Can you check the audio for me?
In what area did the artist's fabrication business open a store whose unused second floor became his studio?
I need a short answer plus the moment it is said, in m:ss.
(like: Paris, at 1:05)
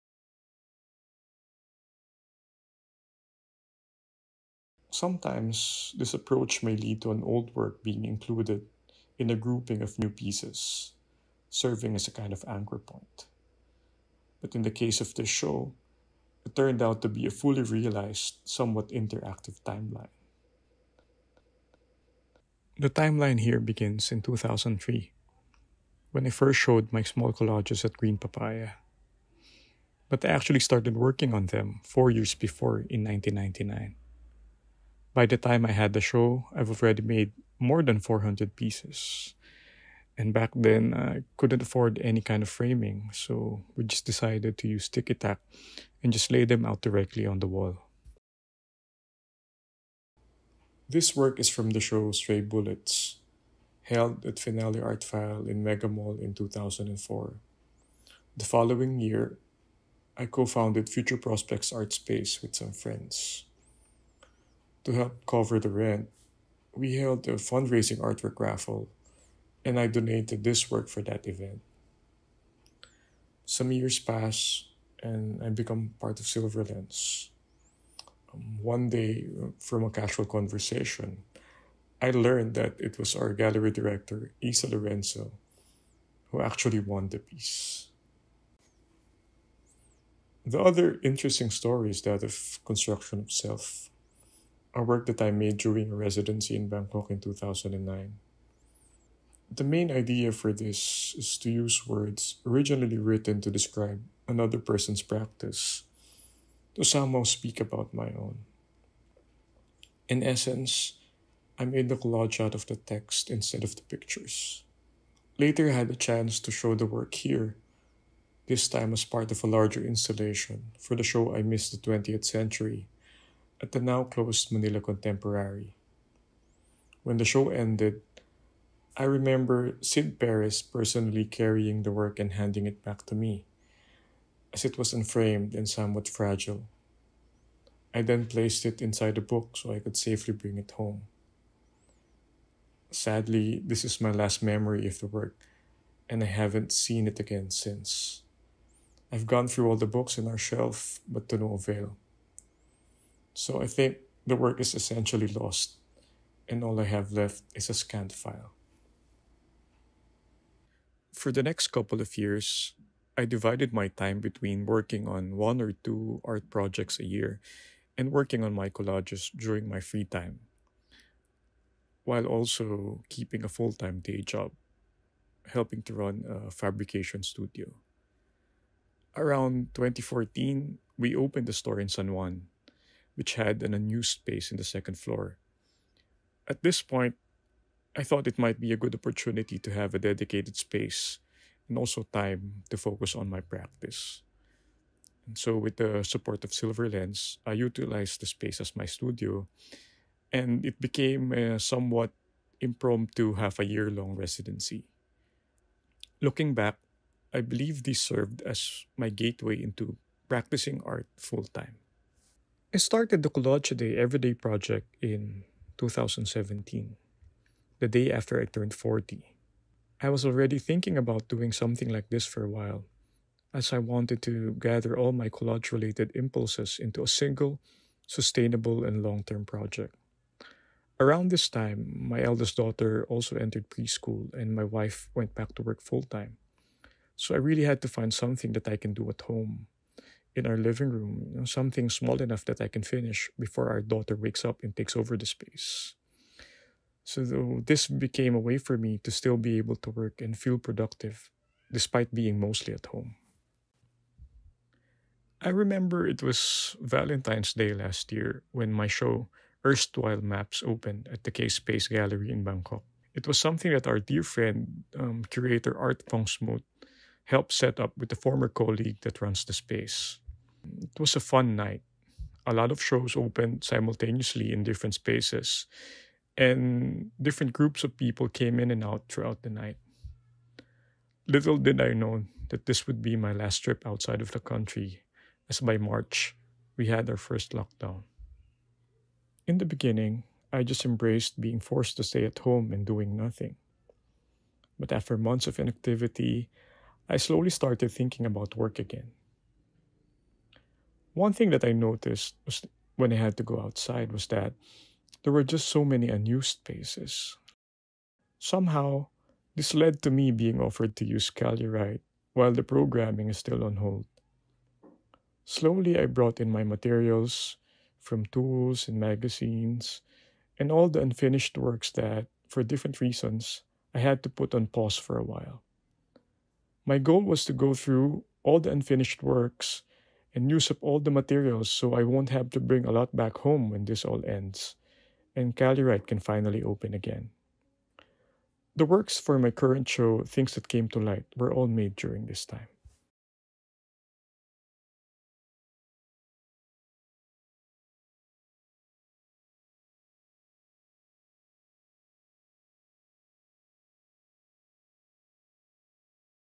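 San Juan, at 3:01.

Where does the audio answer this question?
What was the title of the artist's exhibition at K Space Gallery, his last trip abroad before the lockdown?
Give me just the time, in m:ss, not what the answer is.
4:19.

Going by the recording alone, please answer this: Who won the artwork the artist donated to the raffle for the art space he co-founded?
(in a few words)
Isa Lorenzo.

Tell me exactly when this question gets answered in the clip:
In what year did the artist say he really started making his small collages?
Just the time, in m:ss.
0:33.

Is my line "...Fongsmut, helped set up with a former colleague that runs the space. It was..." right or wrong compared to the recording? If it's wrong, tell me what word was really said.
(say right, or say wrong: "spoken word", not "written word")
right.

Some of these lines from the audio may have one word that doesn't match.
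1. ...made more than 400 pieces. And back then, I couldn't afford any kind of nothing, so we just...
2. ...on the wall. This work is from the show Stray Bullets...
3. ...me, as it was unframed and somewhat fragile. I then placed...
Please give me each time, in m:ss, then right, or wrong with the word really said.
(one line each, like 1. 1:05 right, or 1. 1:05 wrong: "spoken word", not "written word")
1. 0:37 wrong: "framing", not "nothing"
2. 0:47 right
3. 2:13 right.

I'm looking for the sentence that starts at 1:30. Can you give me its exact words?
The other interesting story is that of construction of self a work that I made during a residency in Bangkok in 2009.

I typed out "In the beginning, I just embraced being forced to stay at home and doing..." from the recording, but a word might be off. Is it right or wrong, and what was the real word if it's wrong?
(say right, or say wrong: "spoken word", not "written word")
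right.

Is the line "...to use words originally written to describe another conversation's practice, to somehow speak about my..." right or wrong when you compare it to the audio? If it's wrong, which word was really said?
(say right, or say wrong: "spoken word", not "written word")
wrong: "person", not "conversation".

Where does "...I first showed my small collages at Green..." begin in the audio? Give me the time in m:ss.
0:26.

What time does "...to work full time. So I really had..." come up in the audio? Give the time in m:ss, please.
3:55.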